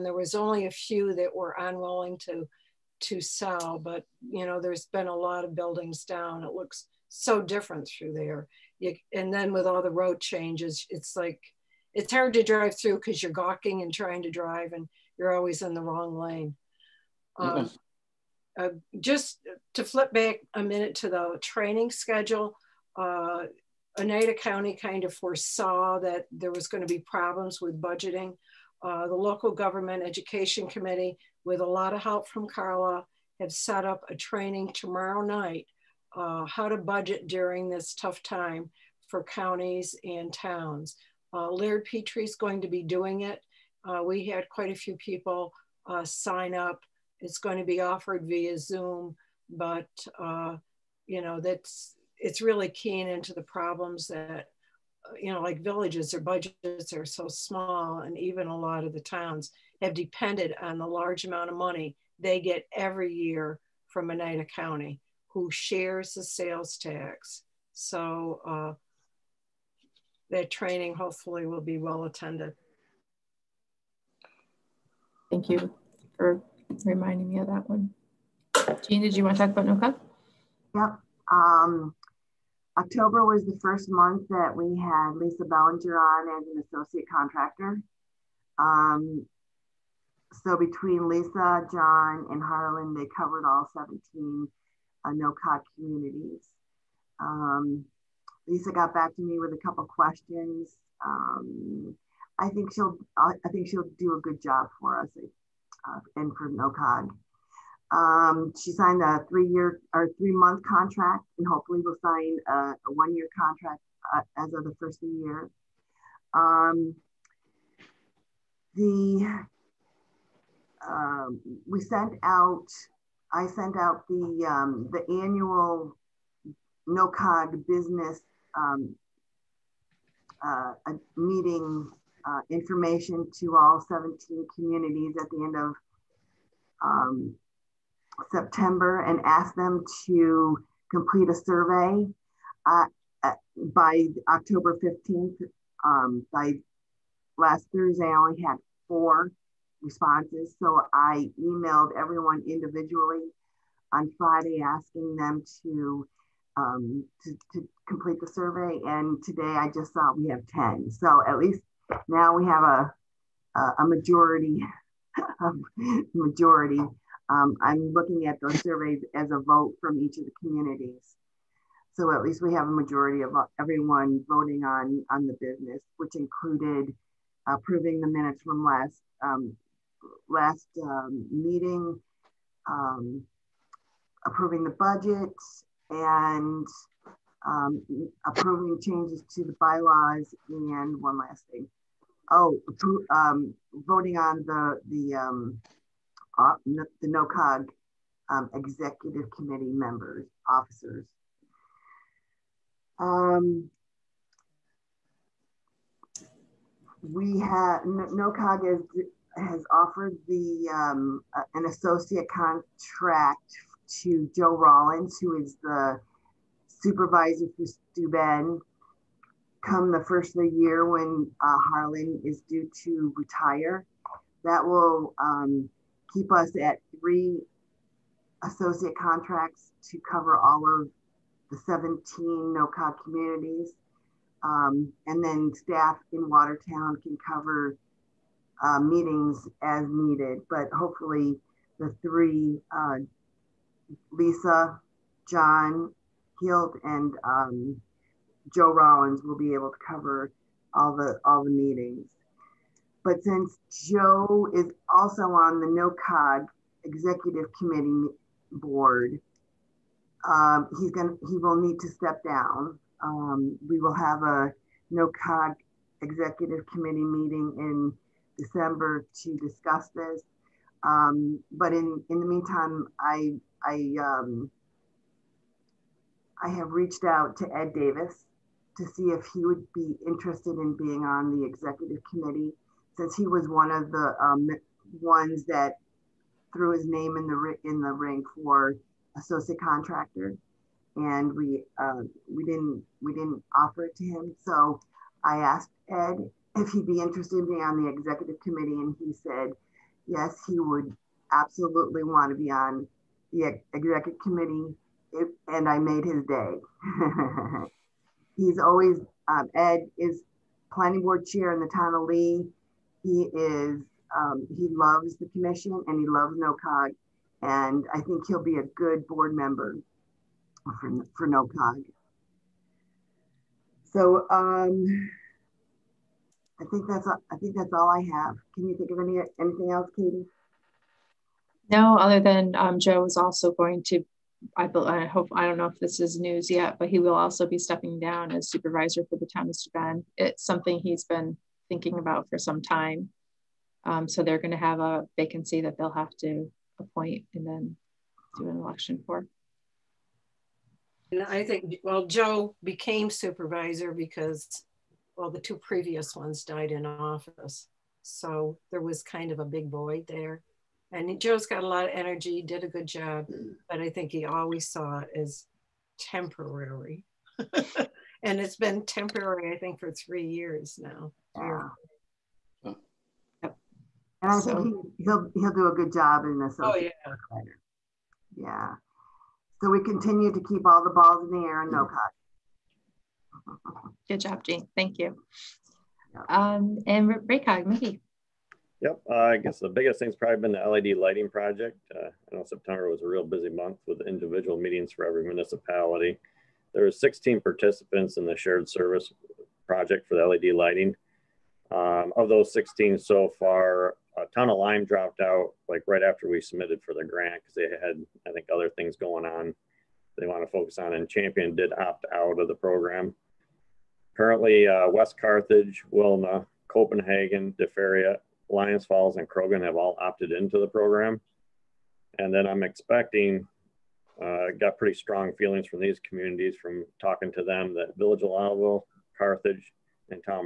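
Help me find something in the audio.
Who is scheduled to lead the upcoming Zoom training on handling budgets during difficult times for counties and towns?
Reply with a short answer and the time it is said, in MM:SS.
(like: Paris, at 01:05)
Laird Petrie, at 00:41.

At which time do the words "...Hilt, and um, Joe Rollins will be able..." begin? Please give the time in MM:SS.
04:06.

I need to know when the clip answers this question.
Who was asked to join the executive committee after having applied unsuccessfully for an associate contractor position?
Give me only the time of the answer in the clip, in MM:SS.
04:37.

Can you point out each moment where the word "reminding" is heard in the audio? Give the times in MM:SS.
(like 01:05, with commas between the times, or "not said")
01:16.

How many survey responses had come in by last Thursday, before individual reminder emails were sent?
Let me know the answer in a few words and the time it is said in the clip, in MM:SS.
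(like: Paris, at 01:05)
4, at 02:28.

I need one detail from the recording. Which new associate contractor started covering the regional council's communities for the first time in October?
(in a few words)
Lisa Bellinger.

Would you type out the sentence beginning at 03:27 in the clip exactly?
we have NOCOG is has offered the um, uh, an associate contract to Joe Rollins, who is the supervisor for Ben.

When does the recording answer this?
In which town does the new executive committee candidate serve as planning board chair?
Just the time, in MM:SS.
05:12.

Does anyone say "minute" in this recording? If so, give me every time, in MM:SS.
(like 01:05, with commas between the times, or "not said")
00:20, 02:58.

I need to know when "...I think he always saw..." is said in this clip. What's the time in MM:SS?
06:03.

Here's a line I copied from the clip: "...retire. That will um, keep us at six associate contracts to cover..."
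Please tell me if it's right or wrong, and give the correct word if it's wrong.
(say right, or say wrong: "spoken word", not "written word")
wrong: "three", not "six".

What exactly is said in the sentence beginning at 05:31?
No, other than um, Joe is also going to.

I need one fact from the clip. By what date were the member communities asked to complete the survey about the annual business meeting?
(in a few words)
October 15.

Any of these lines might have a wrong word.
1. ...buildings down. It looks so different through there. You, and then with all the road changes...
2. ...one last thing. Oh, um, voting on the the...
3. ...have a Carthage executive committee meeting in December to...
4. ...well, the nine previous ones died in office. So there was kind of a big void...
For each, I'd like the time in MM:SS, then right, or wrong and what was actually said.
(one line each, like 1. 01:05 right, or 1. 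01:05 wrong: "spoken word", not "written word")
1. 00:05 right
2. 03:11 right
3. 04:23 wrong: "NOCOG", not "Carthage"
4. 05:55 wrong: "two", not "nine".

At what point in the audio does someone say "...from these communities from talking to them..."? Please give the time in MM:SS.
07:05.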